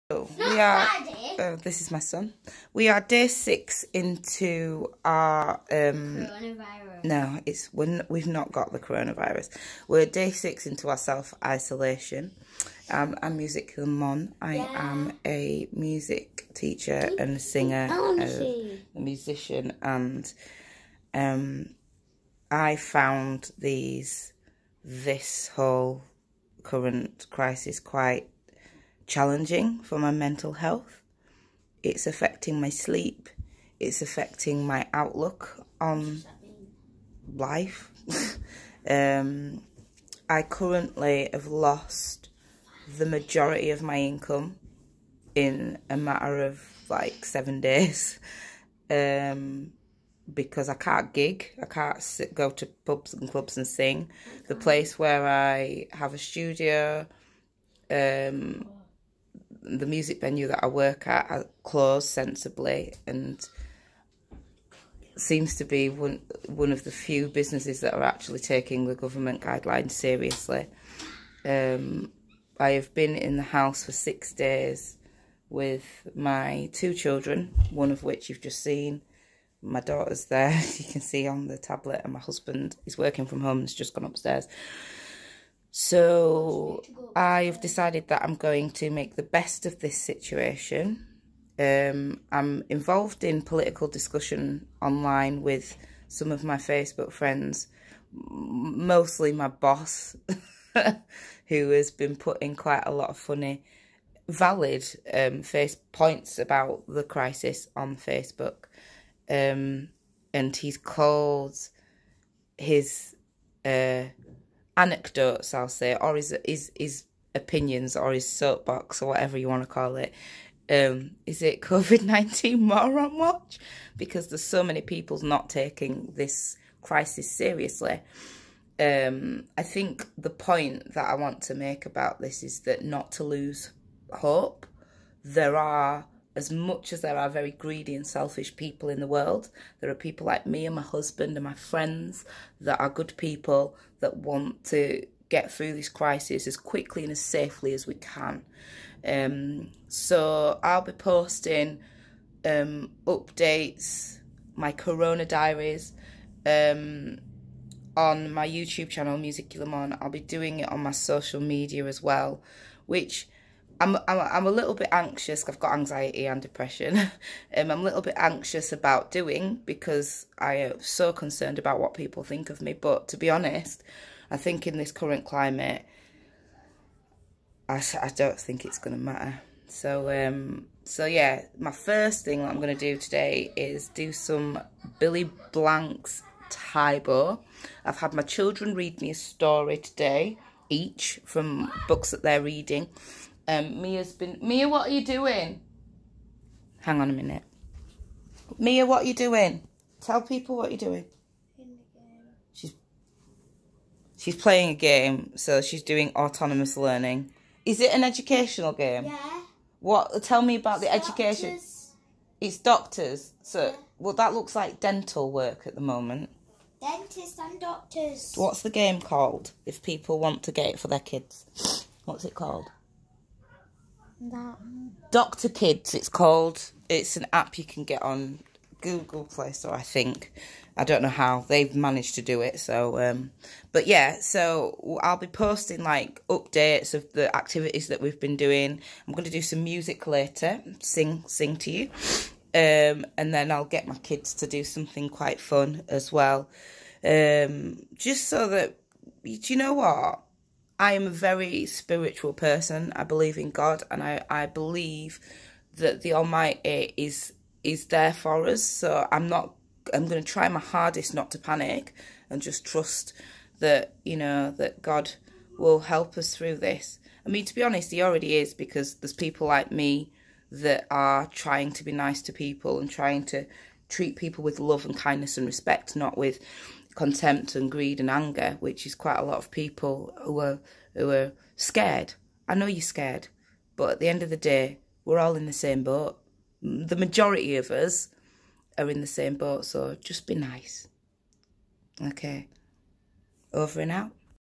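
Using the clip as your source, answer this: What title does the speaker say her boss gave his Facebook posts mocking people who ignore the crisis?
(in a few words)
COVID-19 Moron Watch.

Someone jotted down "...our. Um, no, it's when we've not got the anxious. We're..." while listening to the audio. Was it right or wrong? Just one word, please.
wrong.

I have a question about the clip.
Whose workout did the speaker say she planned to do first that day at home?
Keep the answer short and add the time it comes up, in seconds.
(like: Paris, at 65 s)
Billy Blanks, at 184 s.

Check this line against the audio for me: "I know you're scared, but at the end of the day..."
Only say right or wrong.
right.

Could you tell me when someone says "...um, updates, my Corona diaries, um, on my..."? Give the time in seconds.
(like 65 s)
152 s.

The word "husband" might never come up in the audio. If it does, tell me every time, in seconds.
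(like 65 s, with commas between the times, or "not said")
82 s, 140 s.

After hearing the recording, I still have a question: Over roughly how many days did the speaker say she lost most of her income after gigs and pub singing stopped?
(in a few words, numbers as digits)
7 days.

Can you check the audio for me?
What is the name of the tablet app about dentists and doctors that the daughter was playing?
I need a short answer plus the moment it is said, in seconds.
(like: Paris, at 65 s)
Doctor Kids, at 225 s.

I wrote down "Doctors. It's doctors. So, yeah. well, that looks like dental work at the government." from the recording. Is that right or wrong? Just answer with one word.
wrong.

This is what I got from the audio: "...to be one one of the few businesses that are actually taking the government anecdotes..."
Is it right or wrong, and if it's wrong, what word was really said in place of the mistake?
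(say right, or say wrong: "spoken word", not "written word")
wrong: "guidelines", not "anecdotes".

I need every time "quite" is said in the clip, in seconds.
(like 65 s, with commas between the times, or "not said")
27 s, 102 s, 245 s, 278 s.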